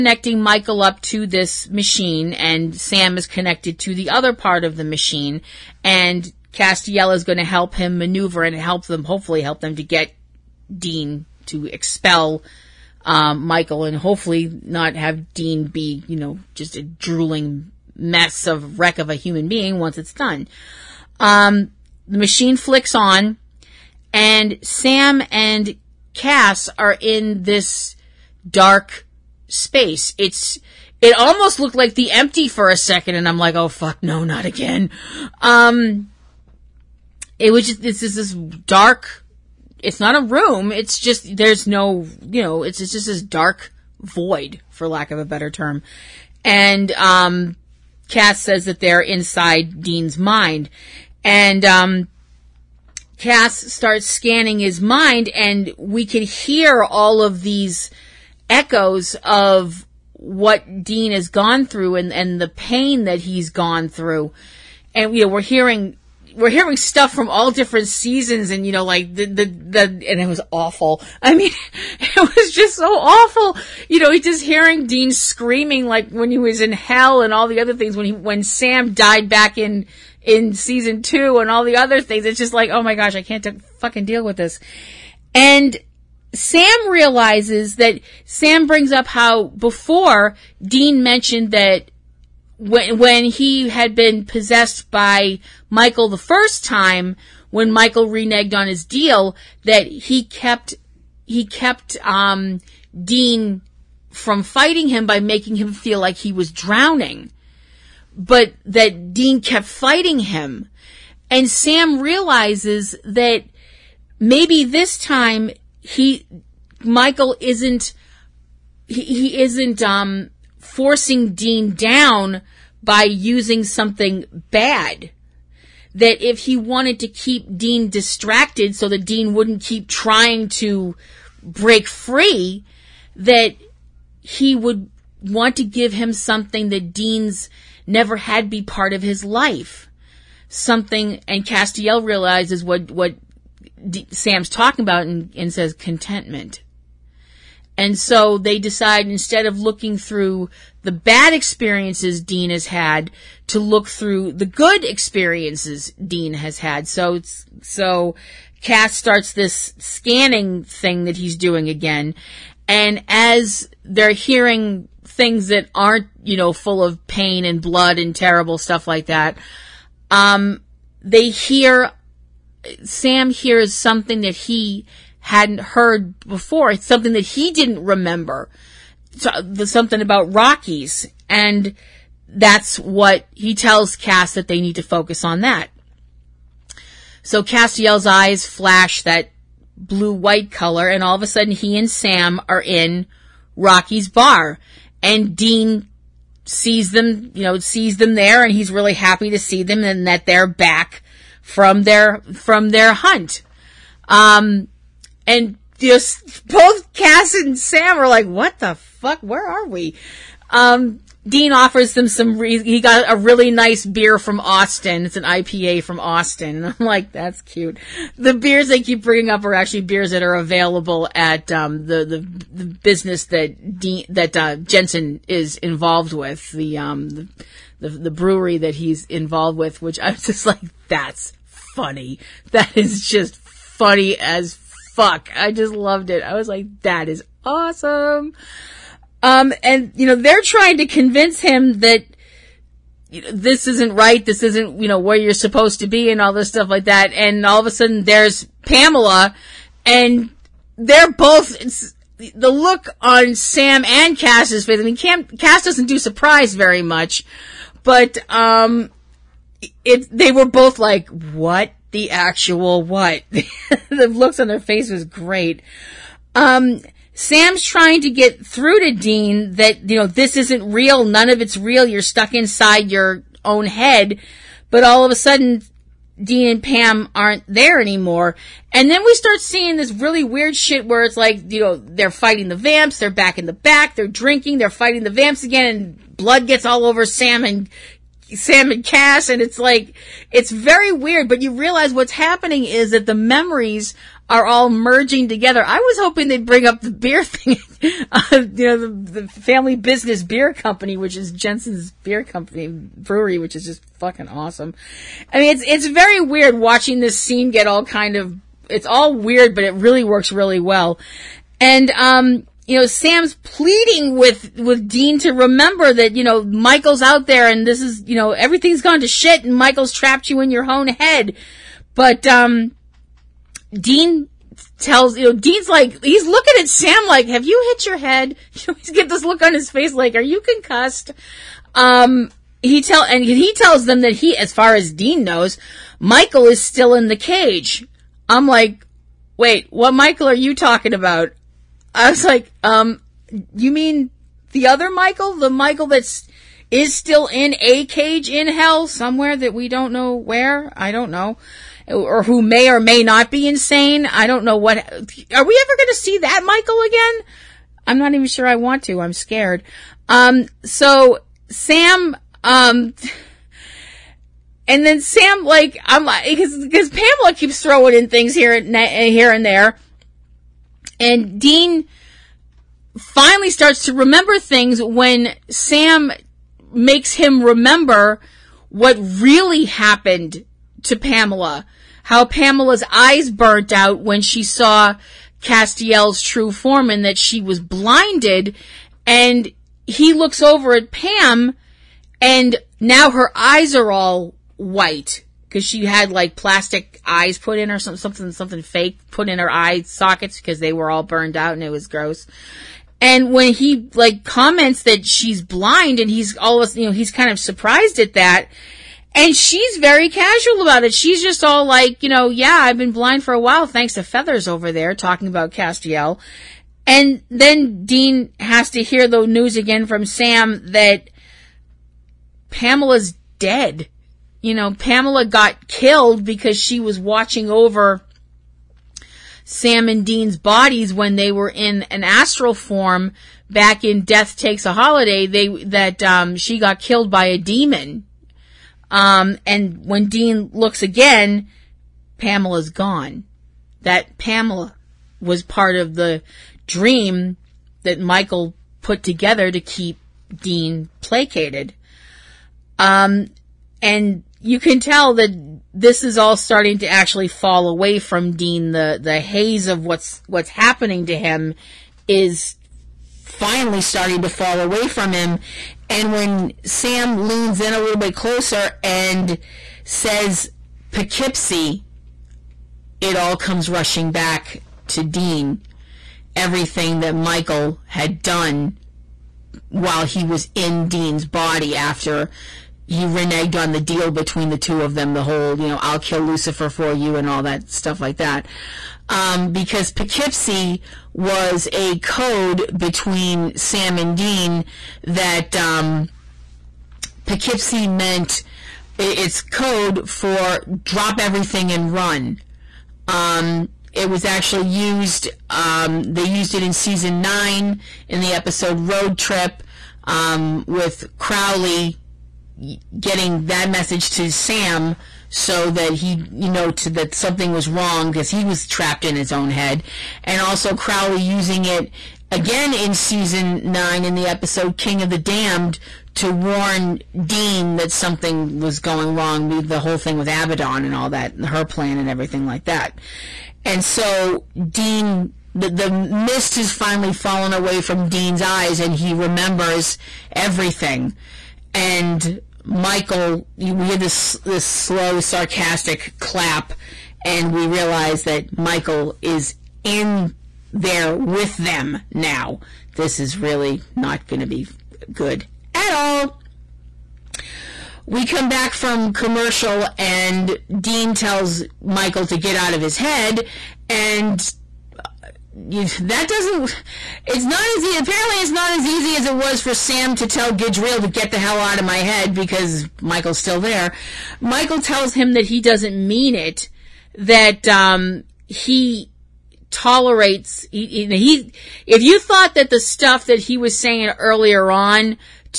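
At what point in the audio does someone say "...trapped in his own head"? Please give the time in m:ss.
8:38.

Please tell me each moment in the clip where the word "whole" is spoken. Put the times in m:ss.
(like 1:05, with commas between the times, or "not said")
8:05, 8:49.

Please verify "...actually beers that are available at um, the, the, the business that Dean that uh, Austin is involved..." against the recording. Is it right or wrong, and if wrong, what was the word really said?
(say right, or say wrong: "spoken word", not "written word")
wrong: "Jensen", not "Austin".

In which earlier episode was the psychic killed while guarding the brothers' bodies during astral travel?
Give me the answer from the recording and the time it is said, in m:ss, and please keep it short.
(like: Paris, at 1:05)
Death Takes a Holiday, at 7:14.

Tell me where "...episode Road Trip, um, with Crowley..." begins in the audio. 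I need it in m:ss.
8:28.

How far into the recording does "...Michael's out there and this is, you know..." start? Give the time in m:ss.
5:16.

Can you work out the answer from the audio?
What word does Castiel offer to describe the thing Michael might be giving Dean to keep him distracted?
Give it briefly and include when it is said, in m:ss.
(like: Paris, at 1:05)
Contentment, at 2:25.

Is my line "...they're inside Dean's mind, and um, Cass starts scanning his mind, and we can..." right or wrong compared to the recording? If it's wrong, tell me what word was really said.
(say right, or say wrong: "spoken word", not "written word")
right.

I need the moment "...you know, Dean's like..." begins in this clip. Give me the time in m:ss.
5:25.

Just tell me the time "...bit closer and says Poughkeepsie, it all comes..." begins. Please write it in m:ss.
7:47.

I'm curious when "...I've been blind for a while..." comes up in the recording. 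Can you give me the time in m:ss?
6:52.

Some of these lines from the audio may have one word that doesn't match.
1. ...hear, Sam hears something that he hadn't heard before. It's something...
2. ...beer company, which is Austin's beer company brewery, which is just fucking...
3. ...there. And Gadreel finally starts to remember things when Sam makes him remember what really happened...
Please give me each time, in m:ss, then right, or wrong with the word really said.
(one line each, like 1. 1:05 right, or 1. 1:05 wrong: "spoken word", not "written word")
1. 2:51 right
2. 5:00 wrong: "Jensen", not "Austin"
3. 6:09 wrong: "Dean", not "Gadreel".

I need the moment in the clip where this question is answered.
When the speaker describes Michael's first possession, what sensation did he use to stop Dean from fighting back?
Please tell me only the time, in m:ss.
1:46.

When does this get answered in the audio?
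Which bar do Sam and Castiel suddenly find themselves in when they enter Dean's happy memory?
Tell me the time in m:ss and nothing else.
3:13.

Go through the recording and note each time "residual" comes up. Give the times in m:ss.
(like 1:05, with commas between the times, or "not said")
not said.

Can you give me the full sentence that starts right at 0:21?
Um, the machine flicks on and Sam and Cass are in this dark space.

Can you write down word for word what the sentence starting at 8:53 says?
And so Dean, the, the mist has finally fallen away from Dean's eyes and he remembers everything.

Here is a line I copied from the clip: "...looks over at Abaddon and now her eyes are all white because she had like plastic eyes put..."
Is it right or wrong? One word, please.
wrong.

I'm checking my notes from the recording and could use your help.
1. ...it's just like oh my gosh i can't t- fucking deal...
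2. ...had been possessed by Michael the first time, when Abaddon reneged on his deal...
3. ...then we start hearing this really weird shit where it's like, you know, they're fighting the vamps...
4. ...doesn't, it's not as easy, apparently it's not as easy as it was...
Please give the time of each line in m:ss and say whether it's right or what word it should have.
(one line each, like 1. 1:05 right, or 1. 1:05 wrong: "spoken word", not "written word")
1. 1:22 right
2. 1:33 wrong: "Michael", not "Abaddon"
3. 4:38 wrong: "seeing", not "hearing"
4. 9:26 right.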